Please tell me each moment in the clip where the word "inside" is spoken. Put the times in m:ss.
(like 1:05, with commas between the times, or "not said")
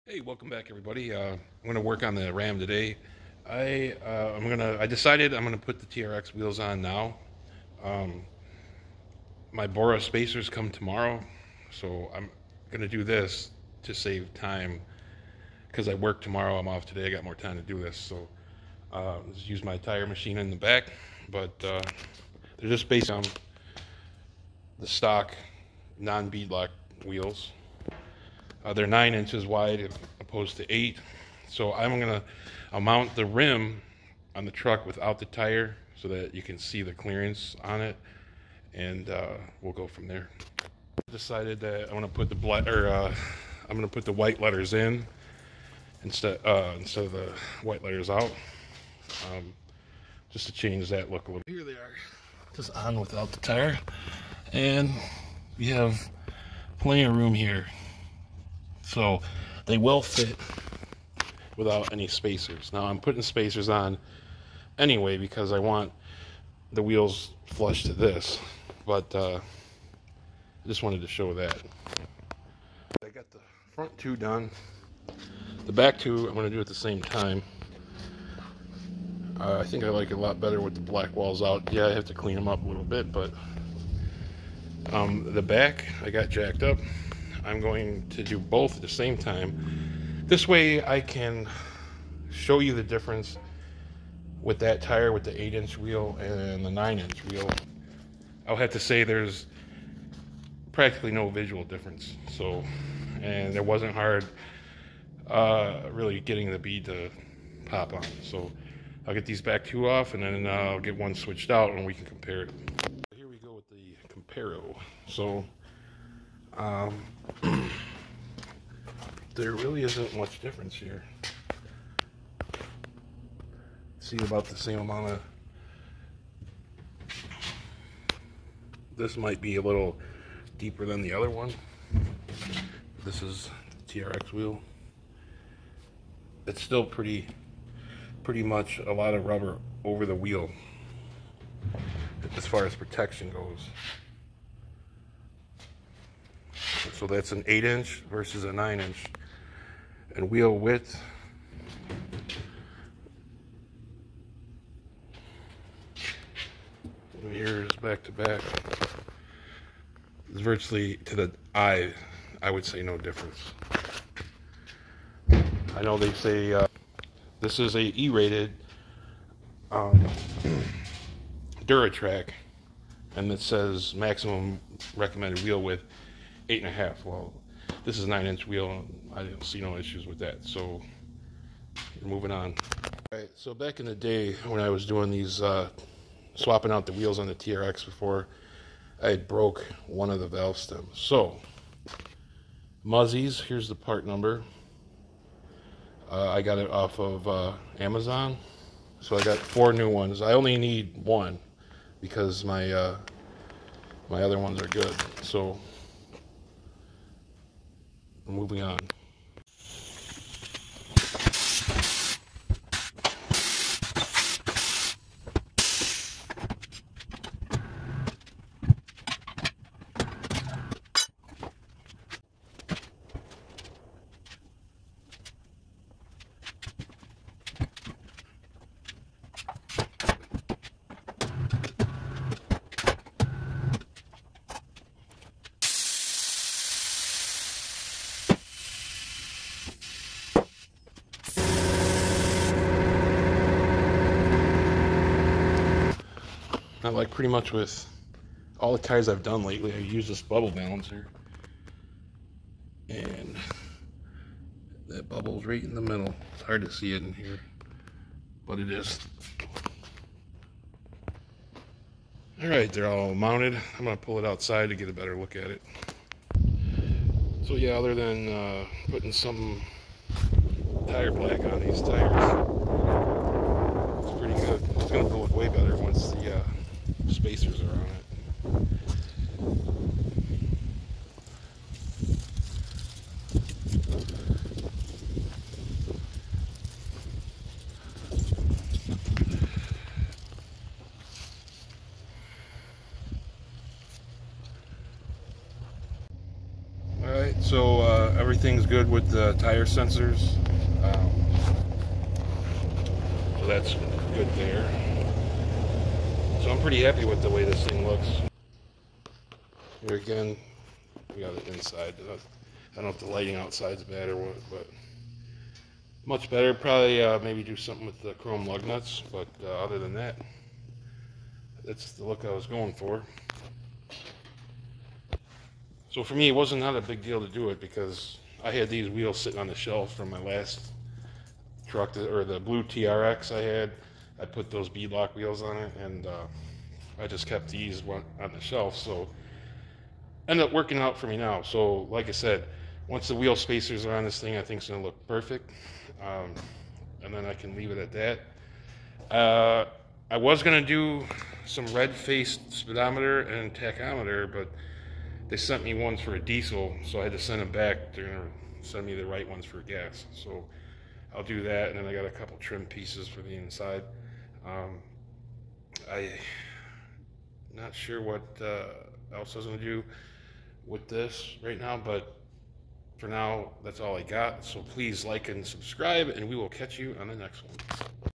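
5:11, 6:03.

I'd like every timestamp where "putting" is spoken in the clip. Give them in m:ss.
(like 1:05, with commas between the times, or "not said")
1:02, 4:28.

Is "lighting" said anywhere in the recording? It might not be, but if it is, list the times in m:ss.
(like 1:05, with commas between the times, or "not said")
5:13.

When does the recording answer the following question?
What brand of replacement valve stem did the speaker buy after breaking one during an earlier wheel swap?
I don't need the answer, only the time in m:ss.
3:12.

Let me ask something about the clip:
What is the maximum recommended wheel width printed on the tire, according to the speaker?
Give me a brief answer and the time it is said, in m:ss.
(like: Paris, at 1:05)
8.5 inches, at 2:56.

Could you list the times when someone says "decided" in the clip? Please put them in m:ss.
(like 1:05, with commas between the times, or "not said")
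0:04, 0:41.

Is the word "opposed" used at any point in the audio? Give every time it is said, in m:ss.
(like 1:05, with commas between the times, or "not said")
0:30.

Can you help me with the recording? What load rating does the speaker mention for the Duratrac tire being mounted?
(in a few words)
E-rated.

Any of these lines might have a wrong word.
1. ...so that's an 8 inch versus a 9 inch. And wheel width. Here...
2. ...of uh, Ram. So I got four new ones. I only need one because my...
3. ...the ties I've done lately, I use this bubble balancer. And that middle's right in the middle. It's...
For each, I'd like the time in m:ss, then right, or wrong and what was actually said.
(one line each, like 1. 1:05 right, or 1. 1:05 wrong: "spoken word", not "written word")
1. 2:27 right
2. 3:16 wrong: "Amazon", not "Ram"
3. 4:08 wrong: "bubble", not "middle".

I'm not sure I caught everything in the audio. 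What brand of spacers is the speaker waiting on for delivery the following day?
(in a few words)
Bora.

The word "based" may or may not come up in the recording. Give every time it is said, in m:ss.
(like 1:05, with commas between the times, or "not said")
0:22.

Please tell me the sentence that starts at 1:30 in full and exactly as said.
This way I can show you the difference with that tire with the 8 inch wheel and the 9 inch wheel.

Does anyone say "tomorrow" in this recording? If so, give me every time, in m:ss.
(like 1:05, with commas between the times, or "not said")
0:10, 0:16.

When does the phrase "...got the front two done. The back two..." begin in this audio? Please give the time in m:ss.
1:13.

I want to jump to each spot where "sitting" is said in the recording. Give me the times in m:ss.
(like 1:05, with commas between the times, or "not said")
5:29.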